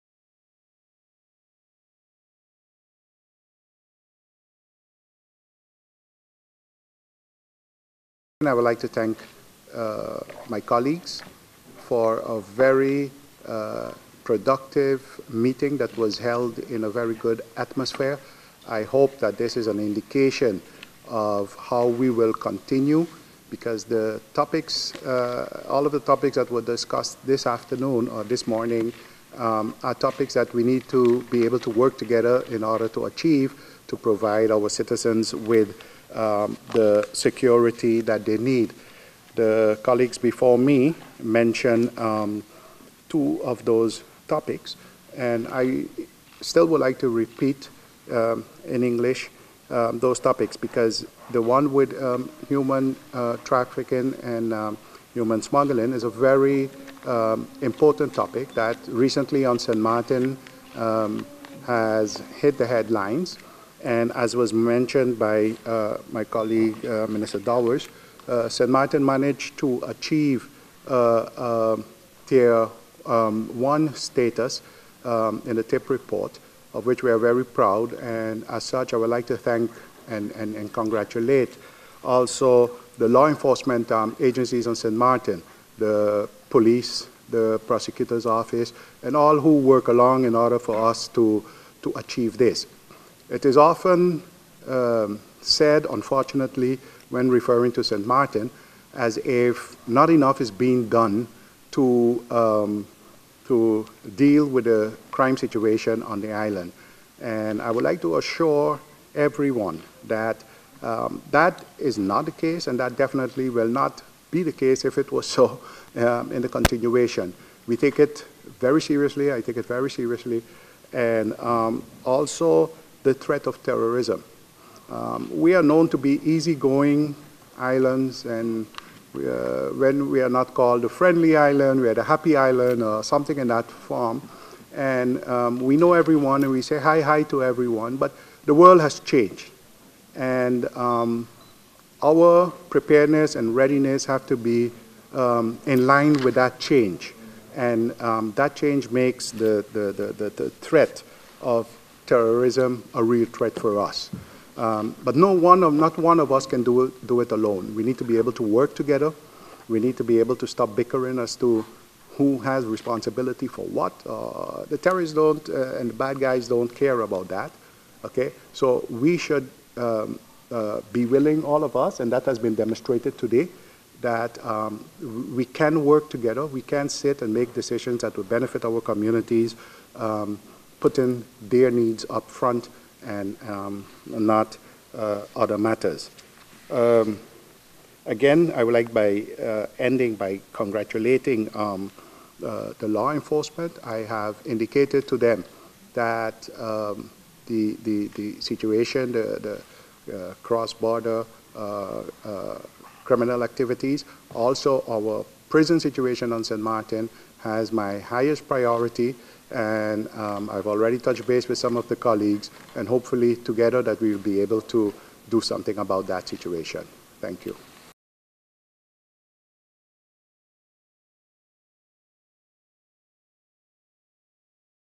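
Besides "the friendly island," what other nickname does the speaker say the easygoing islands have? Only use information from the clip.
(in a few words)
the happy island.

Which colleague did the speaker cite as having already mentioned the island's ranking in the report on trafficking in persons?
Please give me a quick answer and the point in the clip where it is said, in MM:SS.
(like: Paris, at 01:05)
Minister Dowers, at 01:07.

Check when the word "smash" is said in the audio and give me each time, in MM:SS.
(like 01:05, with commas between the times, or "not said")
not said.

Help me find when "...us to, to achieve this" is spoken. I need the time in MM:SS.
01:30.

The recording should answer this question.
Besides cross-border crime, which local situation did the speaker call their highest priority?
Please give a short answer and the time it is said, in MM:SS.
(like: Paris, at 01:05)
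prison situation, at 03:25.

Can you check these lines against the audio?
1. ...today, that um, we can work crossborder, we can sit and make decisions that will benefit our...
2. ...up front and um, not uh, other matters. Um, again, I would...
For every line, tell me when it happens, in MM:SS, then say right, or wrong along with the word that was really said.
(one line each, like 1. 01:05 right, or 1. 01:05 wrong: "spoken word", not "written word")
1. 02:53 wrong: "together", not "crossborder"
2. 03:02 right.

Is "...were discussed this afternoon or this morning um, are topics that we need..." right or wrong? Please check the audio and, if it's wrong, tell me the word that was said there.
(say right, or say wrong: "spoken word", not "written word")
right.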